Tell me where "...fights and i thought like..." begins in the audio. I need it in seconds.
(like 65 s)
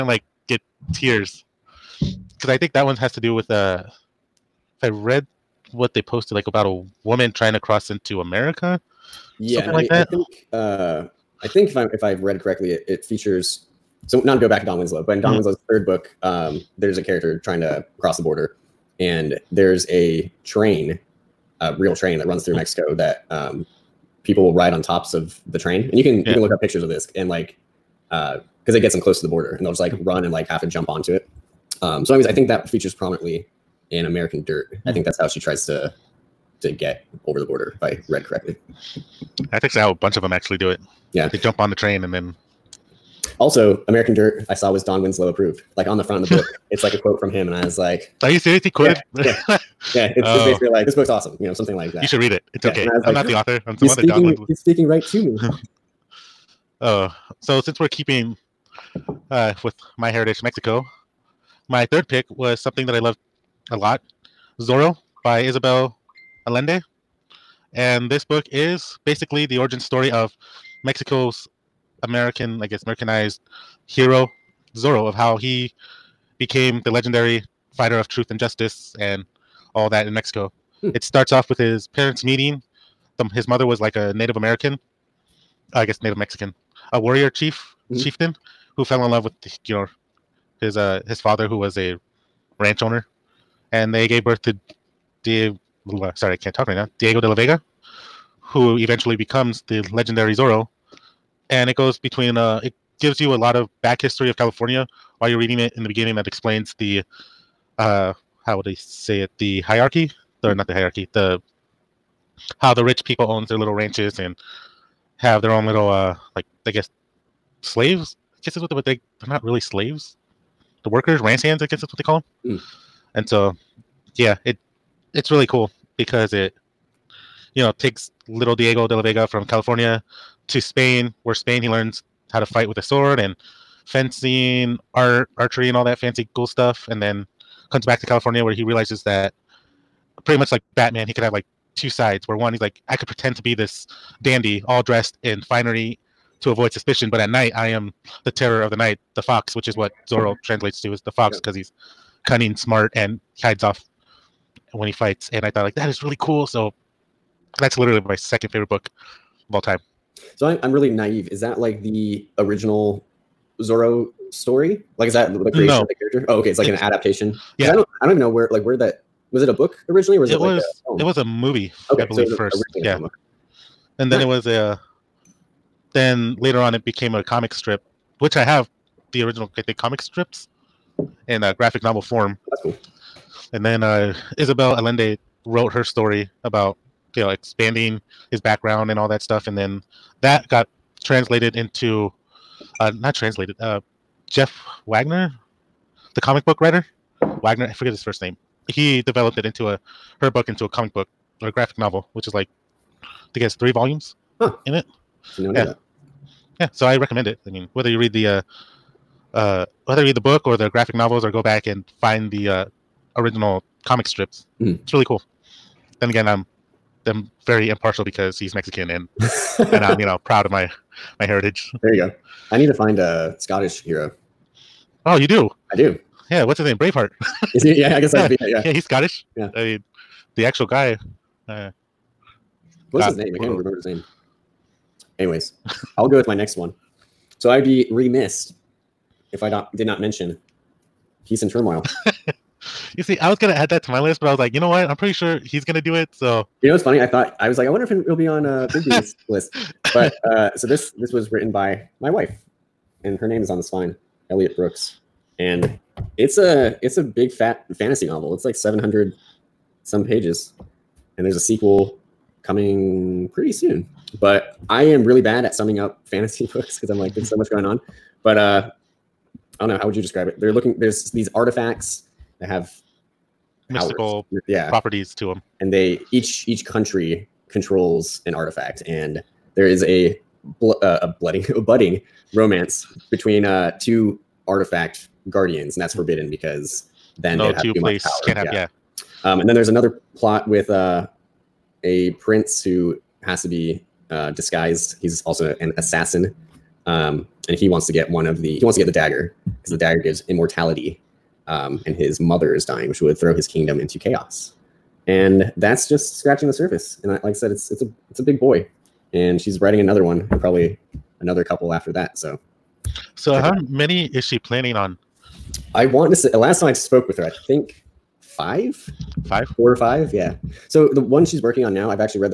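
154 s.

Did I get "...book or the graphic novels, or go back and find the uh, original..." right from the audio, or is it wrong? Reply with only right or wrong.
right.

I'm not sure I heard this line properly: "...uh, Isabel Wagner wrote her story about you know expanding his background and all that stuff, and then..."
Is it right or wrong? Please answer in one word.
wrong.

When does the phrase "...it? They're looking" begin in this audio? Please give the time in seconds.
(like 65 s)
270 s.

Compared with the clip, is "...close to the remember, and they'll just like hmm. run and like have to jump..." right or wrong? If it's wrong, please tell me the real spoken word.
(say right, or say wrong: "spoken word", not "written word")
wrong: "border", not "remember".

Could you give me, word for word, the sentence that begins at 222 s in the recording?
I need to find a Scottish hero.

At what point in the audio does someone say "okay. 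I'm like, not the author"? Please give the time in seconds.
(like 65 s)
52 s.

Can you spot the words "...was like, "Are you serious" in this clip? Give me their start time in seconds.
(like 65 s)
47 s.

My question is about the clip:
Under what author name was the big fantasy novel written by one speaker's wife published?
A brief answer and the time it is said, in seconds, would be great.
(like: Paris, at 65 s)
Elliot Brooks, at 254 s.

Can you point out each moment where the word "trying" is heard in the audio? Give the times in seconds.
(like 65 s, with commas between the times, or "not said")
7 s, 17 s.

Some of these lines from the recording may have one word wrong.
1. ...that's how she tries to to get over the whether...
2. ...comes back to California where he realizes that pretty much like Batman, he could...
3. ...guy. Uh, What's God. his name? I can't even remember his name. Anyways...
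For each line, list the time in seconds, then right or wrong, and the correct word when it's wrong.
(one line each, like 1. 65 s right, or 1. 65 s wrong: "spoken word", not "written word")
1. 35 s wrong: "border", not "whether"
2. 137 s right
3. 230 s right.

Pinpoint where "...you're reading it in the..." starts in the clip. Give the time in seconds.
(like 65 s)
105 s.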